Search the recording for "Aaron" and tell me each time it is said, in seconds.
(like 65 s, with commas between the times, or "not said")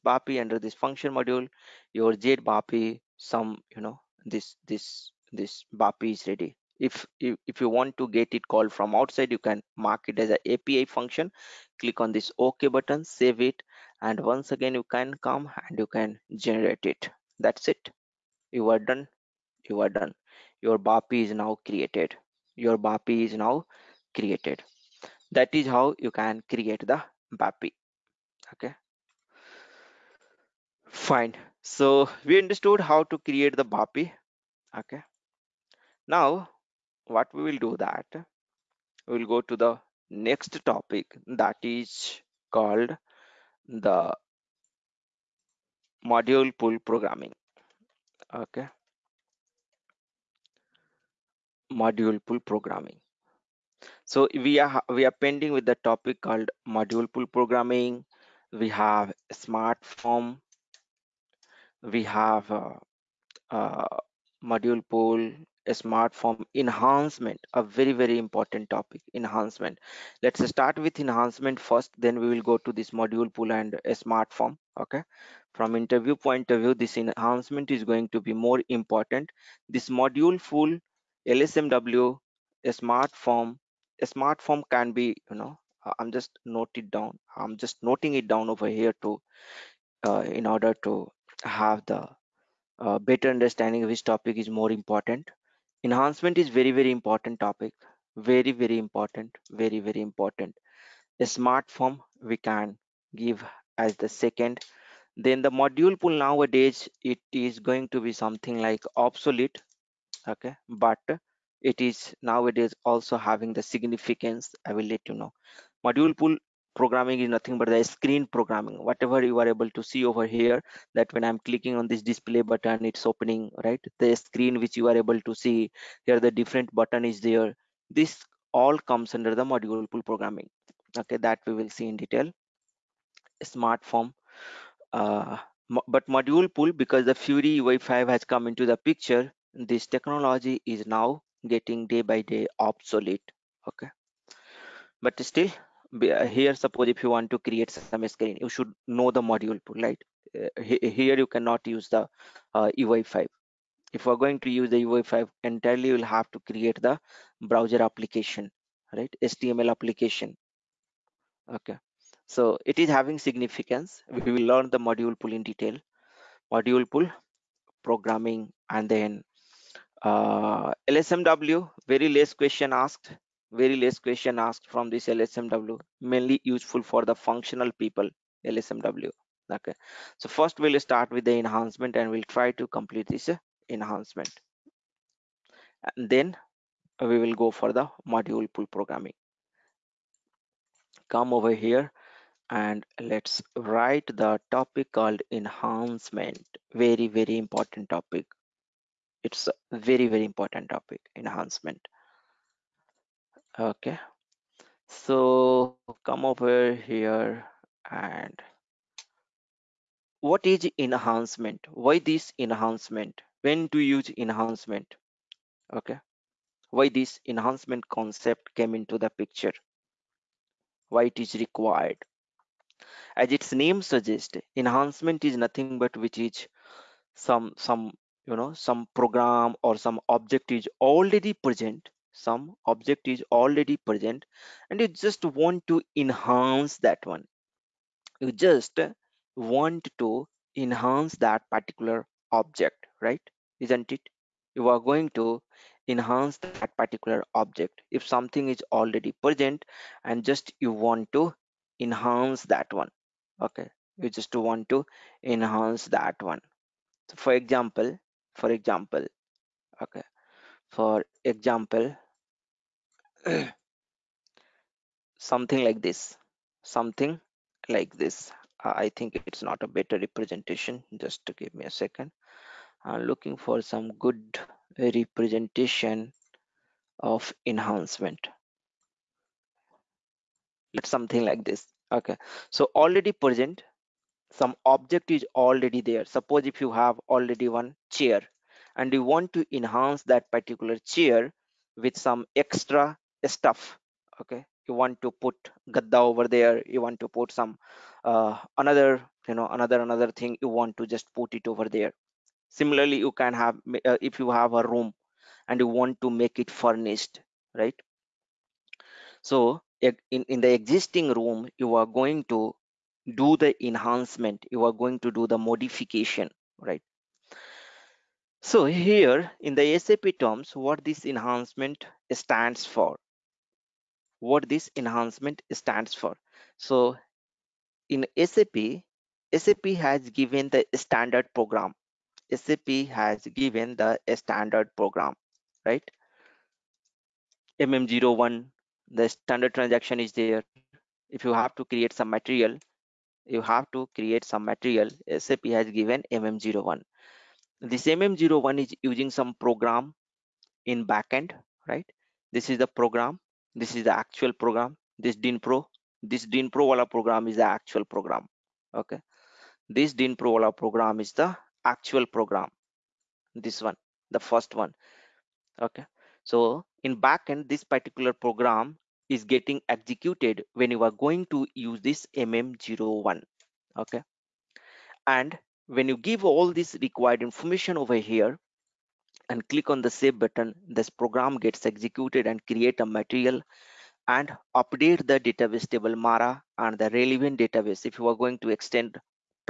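not said.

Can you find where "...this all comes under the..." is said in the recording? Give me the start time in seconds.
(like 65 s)
128 s.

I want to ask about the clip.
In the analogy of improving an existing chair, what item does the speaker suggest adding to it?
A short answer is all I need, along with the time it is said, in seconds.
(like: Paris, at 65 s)
Gadda, at 295 s.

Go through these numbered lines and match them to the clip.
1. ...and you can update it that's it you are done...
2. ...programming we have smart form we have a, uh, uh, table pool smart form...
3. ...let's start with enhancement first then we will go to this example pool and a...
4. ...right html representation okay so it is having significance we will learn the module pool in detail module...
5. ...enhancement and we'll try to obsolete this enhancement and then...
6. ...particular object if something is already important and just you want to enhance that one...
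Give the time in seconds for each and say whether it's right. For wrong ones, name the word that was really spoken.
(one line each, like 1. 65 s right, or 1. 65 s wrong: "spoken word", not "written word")
1. 15 s wrong: "generate", not "update"
2. 57 s wrong: "module", not "table"
3. 70 s wrong: "module", not "example"
4. 158 s wrong: "application", not "representation"
5. 181 s wrong: "complete", not "obsolete"
6. 246 s wrong: "present", not "important".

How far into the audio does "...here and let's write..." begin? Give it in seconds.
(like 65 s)
191 s.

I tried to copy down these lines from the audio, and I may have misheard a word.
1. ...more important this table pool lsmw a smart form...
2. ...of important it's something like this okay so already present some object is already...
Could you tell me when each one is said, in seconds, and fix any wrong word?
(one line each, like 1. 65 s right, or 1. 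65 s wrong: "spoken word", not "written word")
1. 78 s wrong: "module", not "table"
2. 277 s wrong: "enhancement", not "important".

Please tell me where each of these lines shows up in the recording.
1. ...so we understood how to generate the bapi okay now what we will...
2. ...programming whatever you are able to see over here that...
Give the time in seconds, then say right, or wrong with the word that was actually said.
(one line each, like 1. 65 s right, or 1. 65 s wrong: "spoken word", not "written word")
1. 31 s wrong: "create", not "generate"
2. 118 s right.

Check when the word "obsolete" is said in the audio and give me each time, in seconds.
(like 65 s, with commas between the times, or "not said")
108 s, 142 s.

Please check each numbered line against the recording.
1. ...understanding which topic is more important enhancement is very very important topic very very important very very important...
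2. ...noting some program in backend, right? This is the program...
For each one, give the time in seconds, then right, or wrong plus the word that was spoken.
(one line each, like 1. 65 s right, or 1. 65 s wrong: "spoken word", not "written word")
1. 93 s right
2. 348 s wrong: "using", not "noting".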